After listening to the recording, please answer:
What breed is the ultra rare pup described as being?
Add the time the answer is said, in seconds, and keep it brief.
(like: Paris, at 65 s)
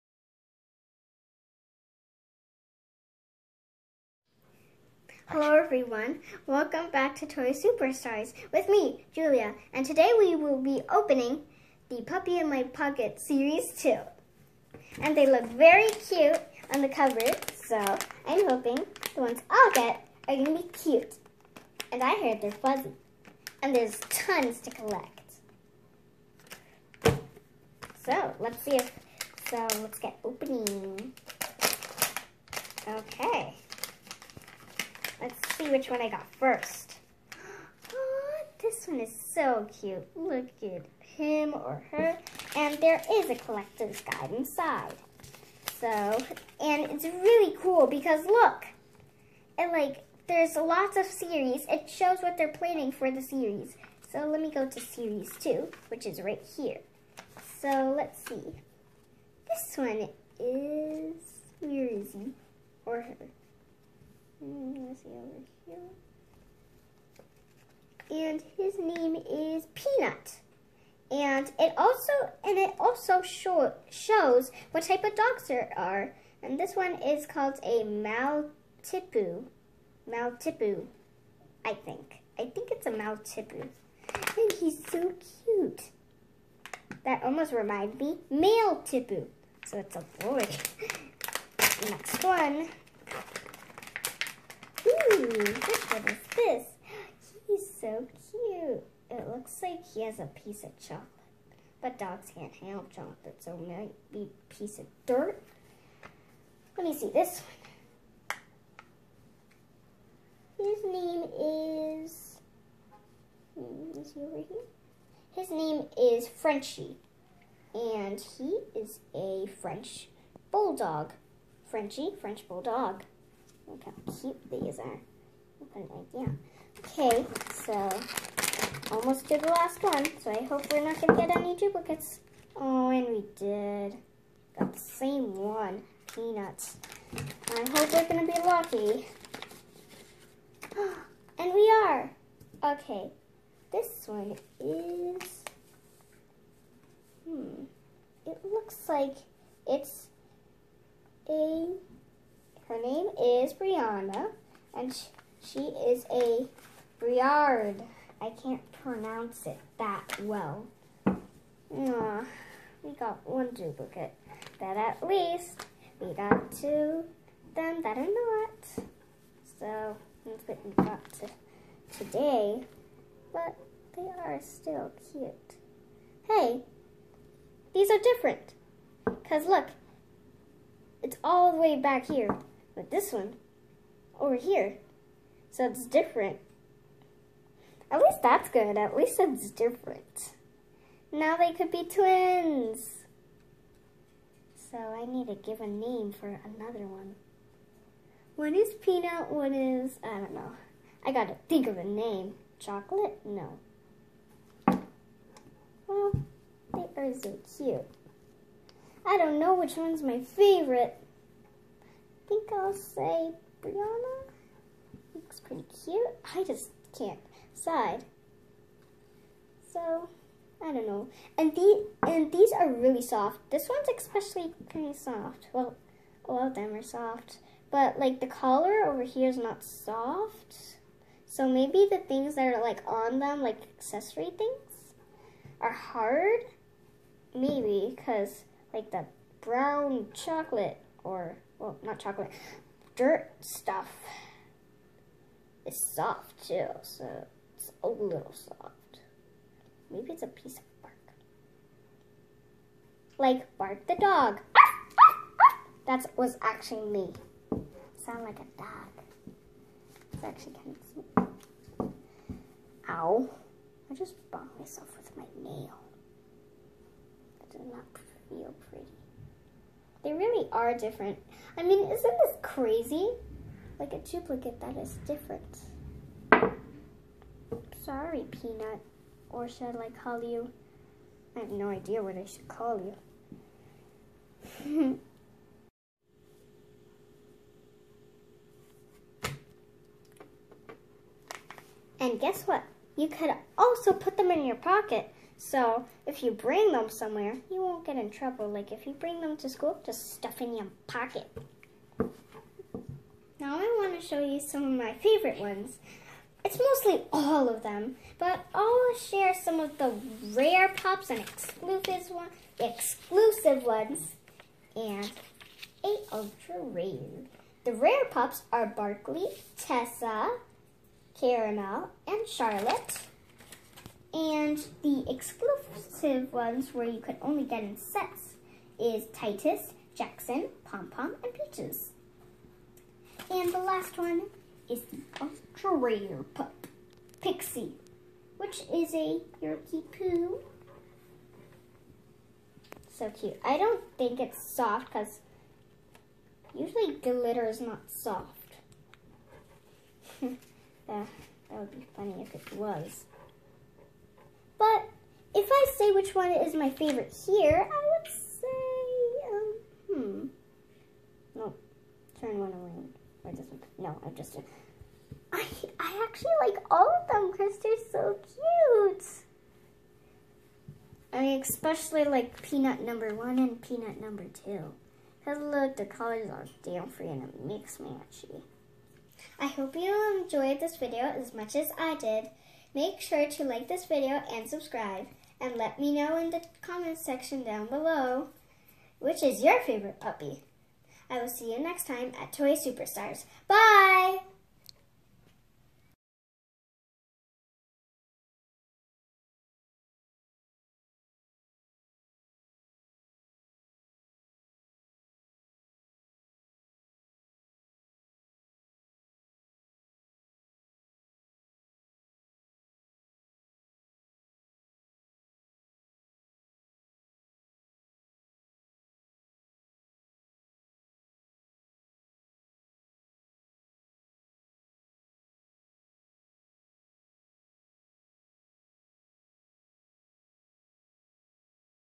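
Yorkie Poo, at 339 s.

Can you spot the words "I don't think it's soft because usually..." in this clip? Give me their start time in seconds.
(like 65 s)
343 s.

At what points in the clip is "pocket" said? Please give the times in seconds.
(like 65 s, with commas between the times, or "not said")
12 s, 294 s, 300 s.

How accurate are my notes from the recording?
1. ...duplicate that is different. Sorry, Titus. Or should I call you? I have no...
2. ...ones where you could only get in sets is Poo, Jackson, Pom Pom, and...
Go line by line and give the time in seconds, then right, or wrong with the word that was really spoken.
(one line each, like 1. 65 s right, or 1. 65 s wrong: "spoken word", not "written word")
1. 274 s wrong: "Peanut", not "Titus"
2. 326 s wrong: "Titus", not "Poo".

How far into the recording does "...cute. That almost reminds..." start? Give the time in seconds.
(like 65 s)
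85 s.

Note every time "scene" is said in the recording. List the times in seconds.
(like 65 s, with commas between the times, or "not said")
not said.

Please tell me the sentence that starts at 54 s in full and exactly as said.
So let me go to series two, which is right here.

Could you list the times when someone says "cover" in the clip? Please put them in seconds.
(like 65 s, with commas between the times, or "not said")
16 s.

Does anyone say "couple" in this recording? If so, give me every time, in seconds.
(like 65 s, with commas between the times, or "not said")
not said.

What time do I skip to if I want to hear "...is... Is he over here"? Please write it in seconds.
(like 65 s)
112 s.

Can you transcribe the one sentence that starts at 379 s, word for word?
I hope you enjoyed this video as much as I did.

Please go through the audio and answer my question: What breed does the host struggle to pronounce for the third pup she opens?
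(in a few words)
Briard.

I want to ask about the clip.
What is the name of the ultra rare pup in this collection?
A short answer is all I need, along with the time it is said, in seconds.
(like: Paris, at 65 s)
Pixie, at 337 s.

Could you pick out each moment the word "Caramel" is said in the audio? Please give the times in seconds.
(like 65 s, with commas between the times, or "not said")
321 s.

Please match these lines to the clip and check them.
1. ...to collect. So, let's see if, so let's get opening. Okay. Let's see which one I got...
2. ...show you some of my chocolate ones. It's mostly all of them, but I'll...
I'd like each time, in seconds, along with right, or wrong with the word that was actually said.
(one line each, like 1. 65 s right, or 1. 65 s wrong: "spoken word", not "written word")
1. 24 s right
2. 304 s wrong: "favorite", not "chocolate".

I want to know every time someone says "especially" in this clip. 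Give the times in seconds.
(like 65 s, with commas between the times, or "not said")
223 s, 371 s.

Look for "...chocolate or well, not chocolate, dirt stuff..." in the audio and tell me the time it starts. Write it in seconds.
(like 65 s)
240 s.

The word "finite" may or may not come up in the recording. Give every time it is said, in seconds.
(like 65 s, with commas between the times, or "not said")
not said.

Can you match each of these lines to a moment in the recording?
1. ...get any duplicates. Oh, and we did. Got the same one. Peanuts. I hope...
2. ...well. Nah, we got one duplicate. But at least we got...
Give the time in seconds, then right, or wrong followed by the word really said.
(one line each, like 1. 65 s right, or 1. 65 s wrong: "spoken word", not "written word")
1. 131 s right
2. 160 s right.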